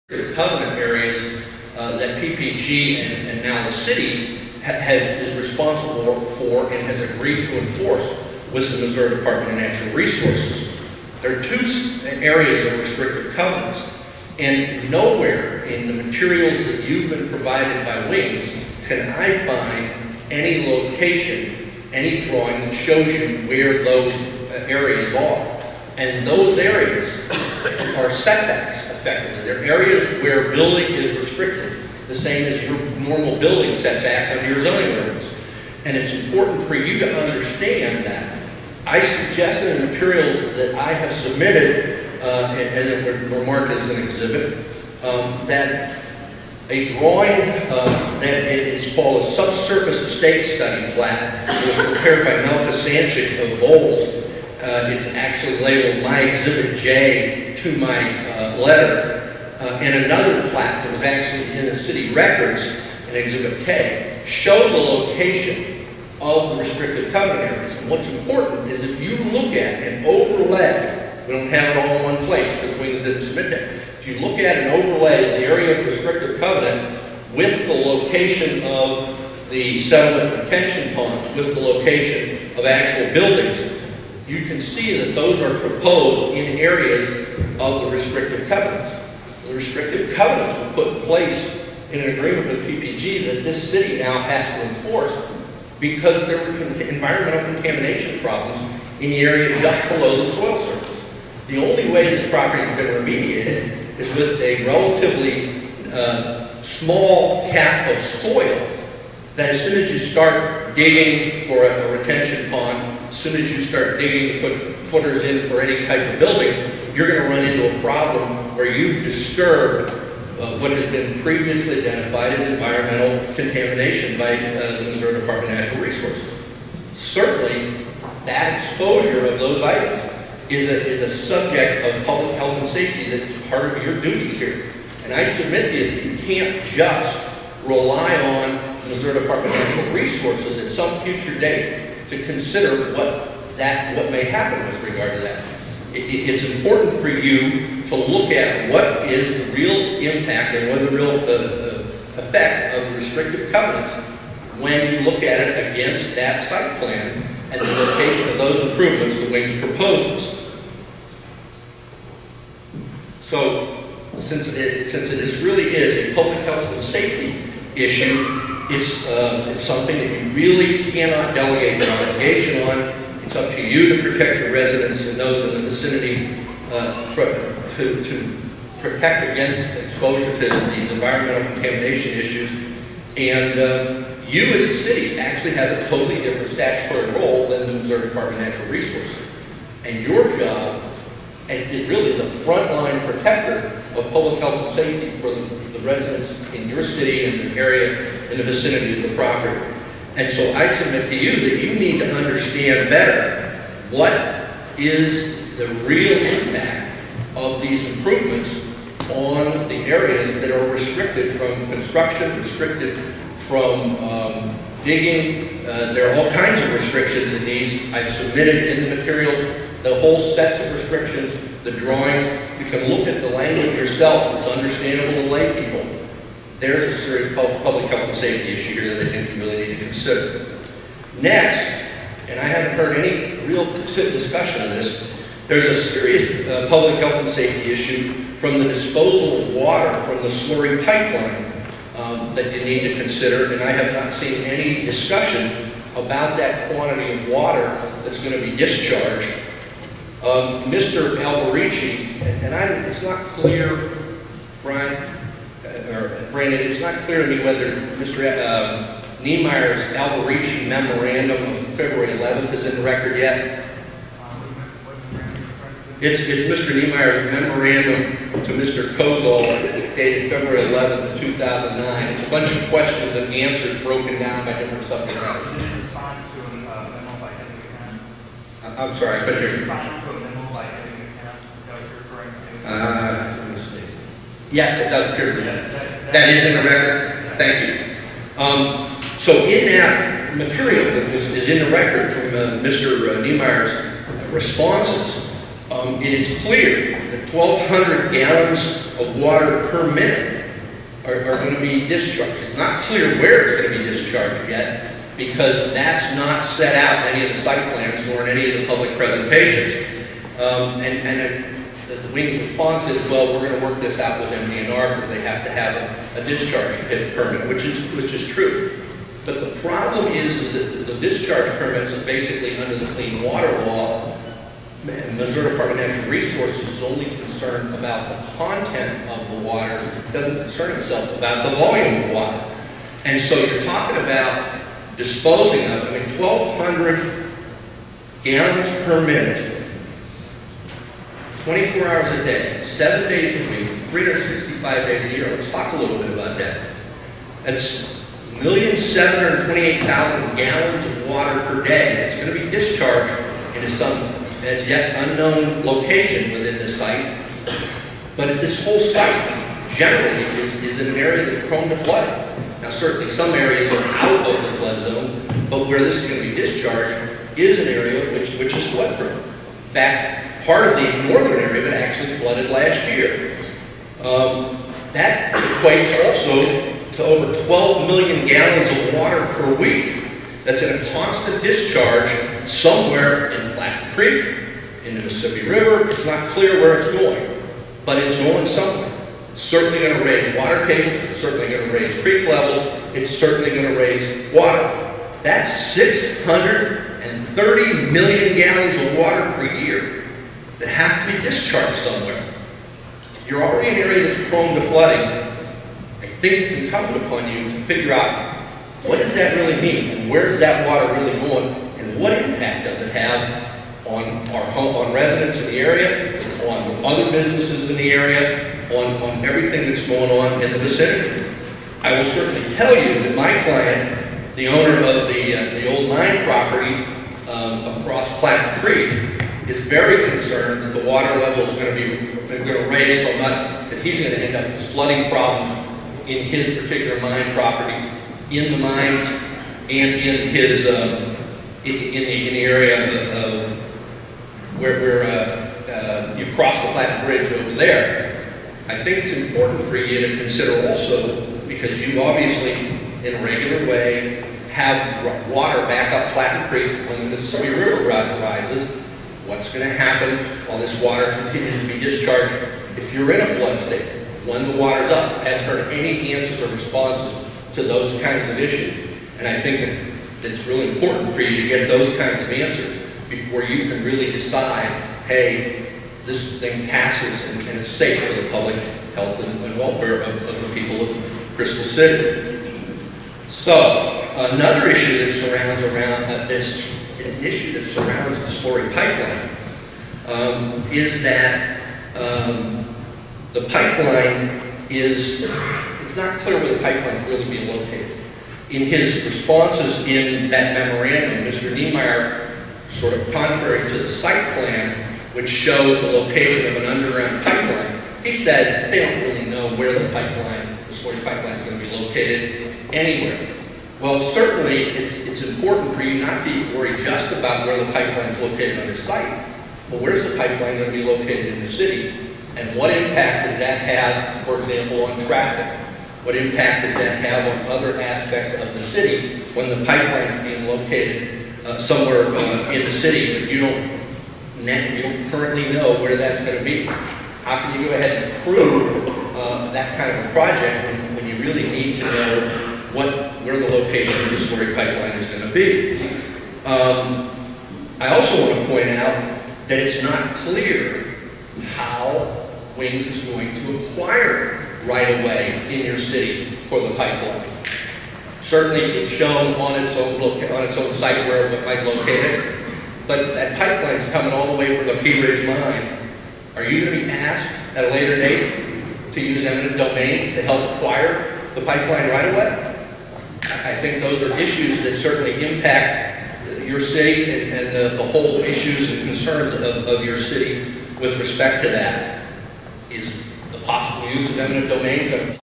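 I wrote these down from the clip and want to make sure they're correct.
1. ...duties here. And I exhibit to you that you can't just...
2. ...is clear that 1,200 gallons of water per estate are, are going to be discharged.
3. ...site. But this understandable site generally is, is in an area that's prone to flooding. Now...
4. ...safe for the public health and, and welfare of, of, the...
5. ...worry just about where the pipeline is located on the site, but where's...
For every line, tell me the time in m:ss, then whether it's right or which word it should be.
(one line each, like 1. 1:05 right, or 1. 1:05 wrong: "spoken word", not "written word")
1. 2:14 wrong: "submit", not "exhibit"
2. 4:56 wrong: "minute", not "estate"
3. 5:56 wrong: "whole", not "understandable"
4. 7:57 right
5. 8:36 right.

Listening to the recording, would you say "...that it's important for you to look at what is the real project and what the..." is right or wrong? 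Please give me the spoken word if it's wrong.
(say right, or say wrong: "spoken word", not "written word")
wrong: "impact", not "project".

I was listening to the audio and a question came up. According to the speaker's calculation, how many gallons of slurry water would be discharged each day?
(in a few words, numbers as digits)
1,728,000.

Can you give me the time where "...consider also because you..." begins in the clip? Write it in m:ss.
7:30.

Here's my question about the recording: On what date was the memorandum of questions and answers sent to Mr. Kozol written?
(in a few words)
February 11th, 2009.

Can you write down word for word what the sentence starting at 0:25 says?
And those areas are setbacks effectively.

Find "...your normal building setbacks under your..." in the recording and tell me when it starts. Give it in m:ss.
0:32.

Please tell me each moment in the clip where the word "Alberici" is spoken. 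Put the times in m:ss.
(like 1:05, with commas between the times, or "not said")
4:11, 4:19.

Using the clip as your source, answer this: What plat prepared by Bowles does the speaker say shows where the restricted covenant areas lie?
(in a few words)
subsurface estate study plat.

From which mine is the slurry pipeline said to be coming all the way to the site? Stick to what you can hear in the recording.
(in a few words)
Pea Ridge mine.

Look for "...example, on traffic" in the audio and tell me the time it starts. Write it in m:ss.
8:44.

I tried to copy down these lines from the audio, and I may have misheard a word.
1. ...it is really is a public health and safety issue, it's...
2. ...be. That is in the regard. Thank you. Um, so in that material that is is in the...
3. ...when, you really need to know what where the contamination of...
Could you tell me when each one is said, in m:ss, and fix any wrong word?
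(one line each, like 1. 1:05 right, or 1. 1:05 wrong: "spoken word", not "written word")
1. 2:45 right
2. 4:45 wrong: "record", not "regard"
3. 9:00 wrong: "location", not "contamination".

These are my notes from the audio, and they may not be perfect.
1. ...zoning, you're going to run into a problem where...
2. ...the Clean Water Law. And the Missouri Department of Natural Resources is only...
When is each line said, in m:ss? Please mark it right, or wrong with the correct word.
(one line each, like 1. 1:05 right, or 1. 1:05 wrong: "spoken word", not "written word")
1. 1:56 wrong: "building", not "zoning"
2. 5:22 right.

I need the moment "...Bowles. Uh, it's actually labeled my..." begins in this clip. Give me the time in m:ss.
0:53.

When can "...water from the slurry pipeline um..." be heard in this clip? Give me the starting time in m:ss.
3:59.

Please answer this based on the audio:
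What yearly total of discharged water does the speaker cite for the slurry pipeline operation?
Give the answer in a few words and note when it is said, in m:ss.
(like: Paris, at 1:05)
630 million gallons, at 6:35.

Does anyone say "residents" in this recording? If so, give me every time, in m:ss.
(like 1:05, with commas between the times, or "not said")
2:54, 3:15, 6:54.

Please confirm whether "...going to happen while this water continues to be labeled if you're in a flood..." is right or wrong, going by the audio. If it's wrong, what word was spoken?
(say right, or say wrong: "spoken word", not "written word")
wrong: "discharged", not "labeled".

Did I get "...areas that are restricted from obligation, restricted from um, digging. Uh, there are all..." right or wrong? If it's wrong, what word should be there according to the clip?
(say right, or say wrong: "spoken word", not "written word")
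wrong: "construction", not "obligation".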